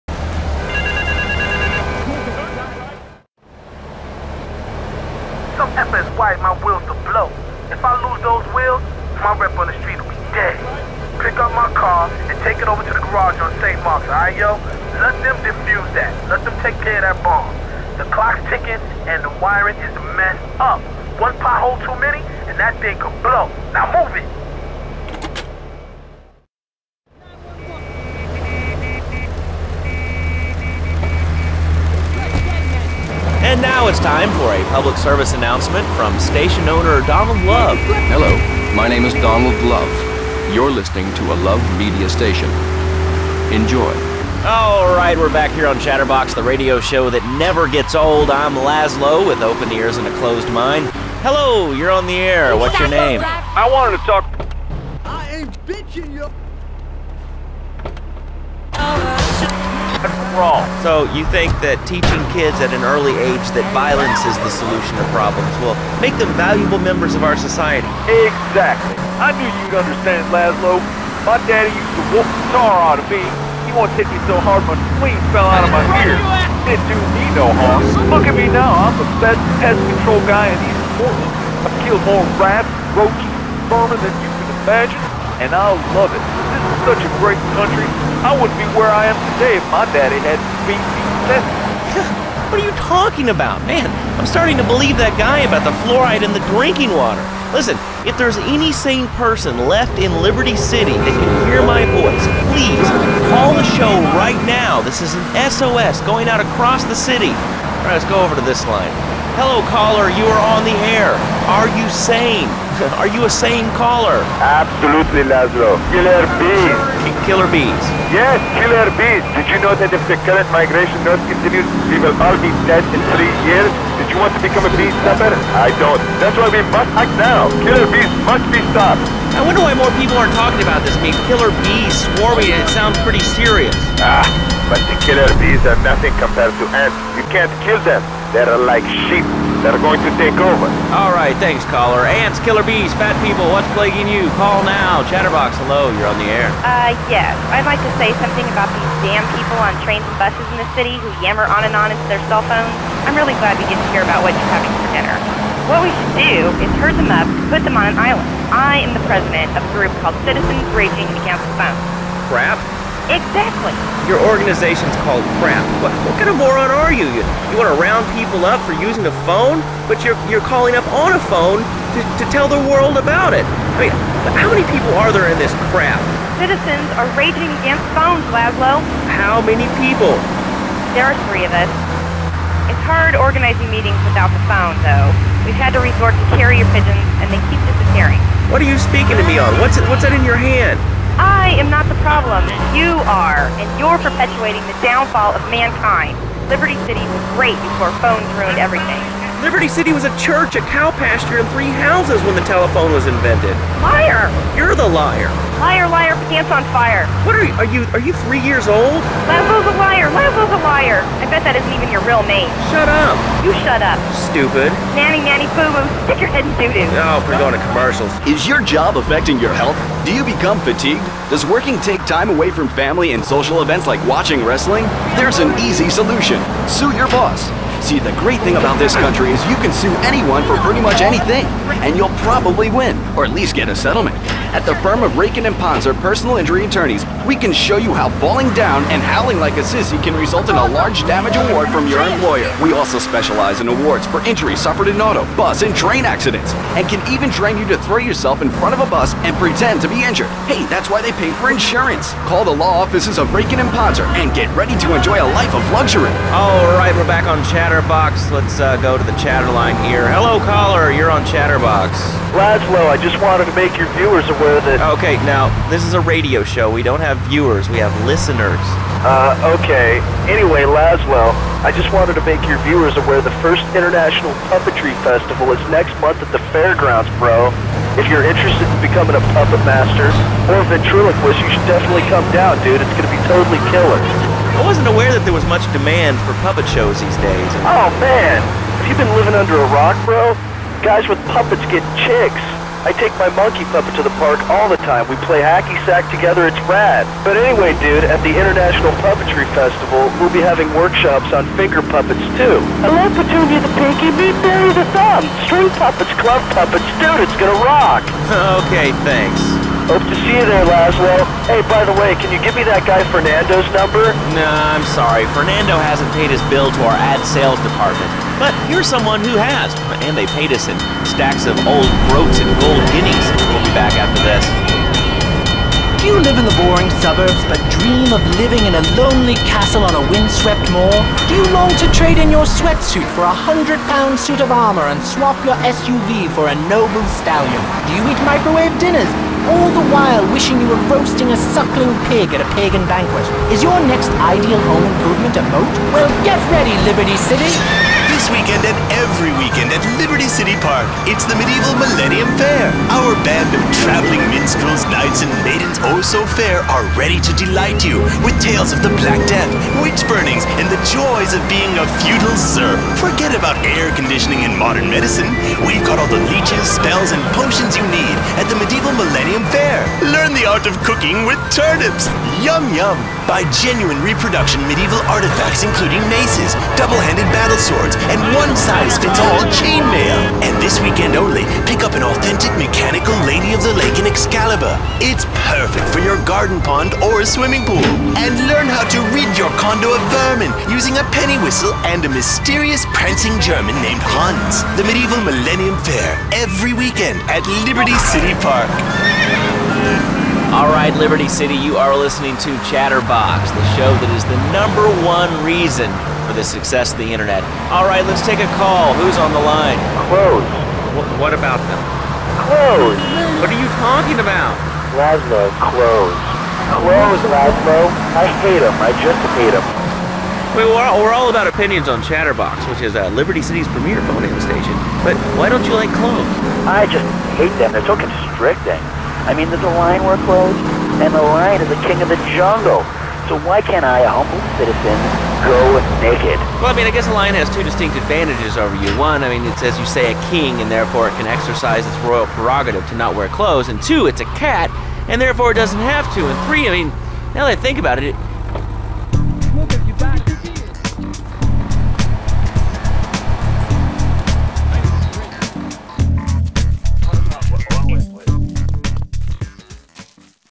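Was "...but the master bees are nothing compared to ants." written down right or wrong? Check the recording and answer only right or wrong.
wrong.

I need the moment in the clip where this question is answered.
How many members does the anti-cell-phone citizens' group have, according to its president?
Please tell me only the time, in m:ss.
3:01.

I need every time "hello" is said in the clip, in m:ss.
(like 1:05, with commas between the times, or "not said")
0:38, 0:51, 1:49, 2:25, 4:20.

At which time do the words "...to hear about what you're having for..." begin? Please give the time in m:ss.
2:33.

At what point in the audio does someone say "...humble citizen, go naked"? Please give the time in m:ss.
7:14.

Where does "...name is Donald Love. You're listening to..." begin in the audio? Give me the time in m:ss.
0:38.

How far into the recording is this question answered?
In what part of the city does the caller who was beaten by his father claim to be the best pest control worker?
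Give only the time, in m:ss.
1:20.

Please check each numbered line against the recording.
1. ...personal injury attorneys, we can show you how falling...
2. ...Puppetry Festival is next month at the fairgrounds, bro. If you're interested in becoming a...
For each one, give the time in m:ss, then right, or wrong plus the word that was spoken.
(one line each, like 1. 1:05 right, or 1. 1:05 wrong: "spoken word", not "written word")
1. 3:56 right
2. 4:34 right.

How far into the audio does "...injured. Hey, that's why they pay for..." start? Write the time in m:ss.
4:10.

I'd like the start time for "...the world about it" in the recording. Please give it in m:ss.
2:52.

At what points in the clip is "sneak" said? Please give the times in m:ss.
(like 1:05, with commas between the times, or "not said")
not said.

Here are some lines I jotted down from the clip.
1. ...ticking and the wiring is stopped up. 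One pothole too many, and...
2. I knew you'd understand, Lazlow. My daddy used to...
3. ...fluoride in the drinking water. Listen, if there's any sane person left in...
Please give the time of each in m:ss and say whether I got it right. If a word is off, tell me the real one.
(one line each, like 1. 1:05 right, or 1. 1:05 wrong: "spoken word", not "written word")
1. 0:18 wrong: "messed", not "stopped"
2. 1:09 right
3. 1:35 right.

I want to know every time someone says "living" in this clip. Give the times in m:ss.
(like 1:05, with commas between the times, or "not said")
4:49, 5:28.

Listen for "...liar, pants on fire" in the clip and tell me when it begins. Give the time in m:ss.
3:25.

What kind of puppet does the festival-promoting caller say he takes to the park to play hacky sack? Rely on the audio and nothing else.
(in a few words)
monkey puppet.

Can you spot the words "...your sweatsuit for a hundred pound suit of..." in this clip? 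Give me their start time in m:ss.
5:32.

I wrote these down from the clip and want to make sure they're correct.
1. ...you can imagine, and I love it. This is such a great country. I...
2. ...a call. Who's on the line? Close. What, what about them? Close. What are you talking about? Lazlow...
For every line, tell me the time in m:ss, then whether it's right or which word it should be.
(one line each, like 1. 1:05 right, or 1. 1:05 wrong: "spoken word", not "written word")
1. 1:24 right
2. 6:48 right.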